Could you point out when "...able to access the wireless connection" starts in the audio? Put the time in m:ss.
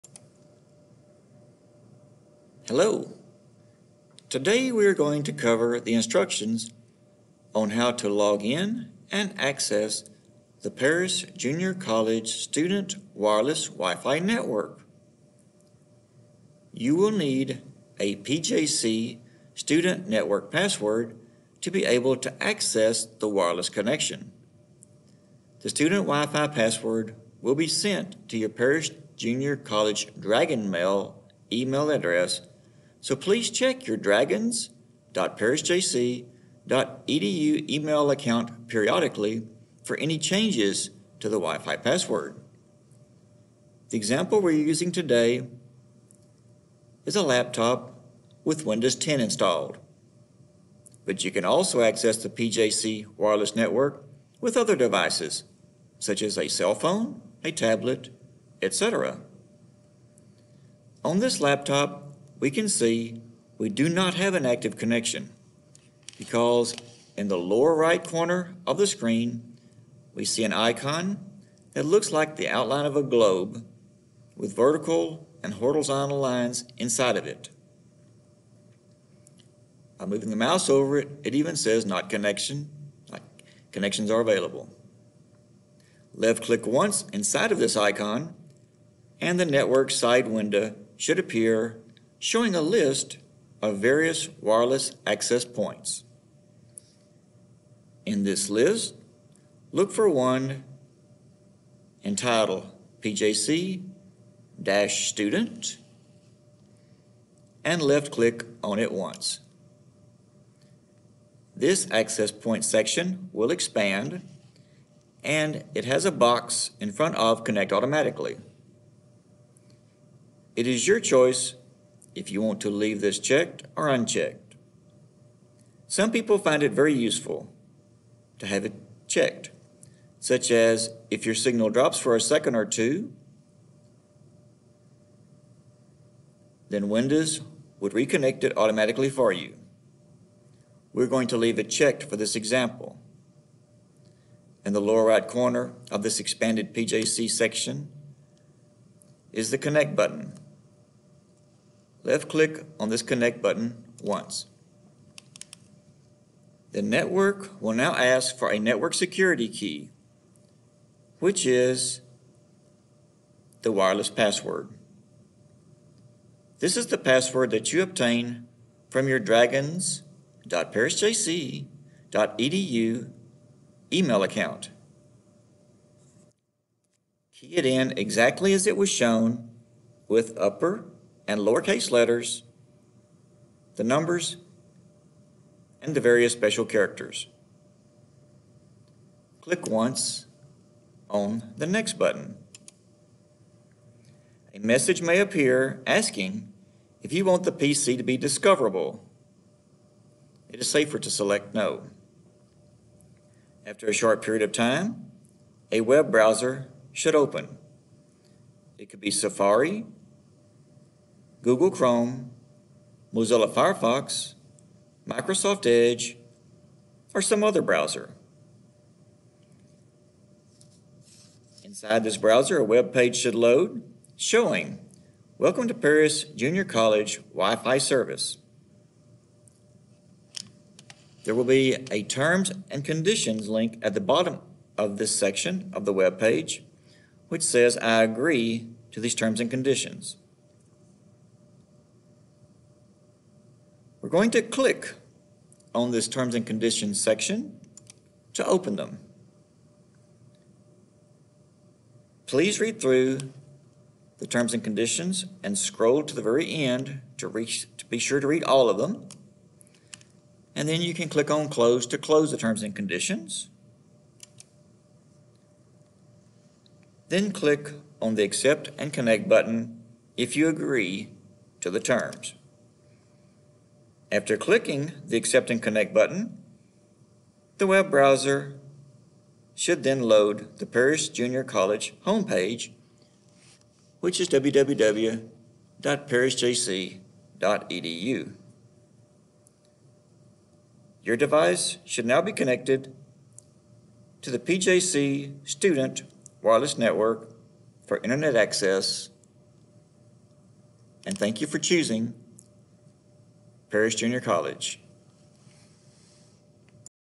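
0:21.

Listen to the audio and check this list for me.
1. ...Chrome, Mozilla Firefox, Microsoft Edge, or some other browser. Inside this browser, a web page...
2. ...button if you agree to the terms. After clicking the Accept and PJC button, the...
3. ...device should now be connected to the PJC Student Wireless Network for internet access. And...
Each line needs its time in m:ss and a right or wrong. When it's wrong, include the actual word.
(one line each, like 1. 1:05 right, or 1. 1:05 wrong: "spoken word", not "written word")
1. 3:31 right
2. 4:29 wrong: "Connect", not "PJC"
3. 4:51 right.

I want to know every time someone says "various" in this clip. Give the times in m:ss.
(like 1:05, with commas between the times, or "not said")
1:33, 3:06.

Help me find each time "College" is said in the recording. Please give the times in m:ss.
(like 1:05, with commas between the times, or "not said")
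0:11, 0:29, 3:46, 4:41, 5:04.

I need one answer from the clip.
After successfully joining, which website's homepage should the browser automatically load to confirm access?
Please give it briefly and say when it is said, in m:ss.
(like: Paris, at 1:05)
www.parisjc.edu, at 4:44.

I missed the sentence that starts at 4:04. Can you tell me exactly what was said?
going to click on this terms and conditions section to open them.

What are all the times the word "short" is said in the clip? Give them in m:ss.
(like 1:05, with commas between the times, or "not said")
3:23.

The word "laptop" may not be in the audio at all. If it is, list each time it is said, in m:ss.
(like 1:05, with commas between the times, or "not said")
0:47, 1:01.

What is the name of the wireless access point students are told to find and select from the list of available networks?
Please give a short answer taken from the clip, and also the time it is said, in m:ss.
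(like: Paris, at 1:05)
PJC-Student, at 1:43.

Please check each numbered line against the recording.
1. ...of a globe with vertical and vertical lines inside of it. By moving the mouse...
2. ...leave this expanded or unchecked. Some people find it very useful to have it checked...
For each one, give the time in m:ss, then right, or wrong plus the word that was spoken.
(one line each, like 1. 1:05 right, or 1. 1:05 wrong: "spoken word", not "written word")
1. 1:12 wrong: "horizontal", not "vertical"
2. 2:02 wrong: "checked", not "expanded".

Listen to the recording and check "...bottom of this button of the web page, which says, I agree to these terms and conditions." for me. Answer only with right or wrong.
wrong.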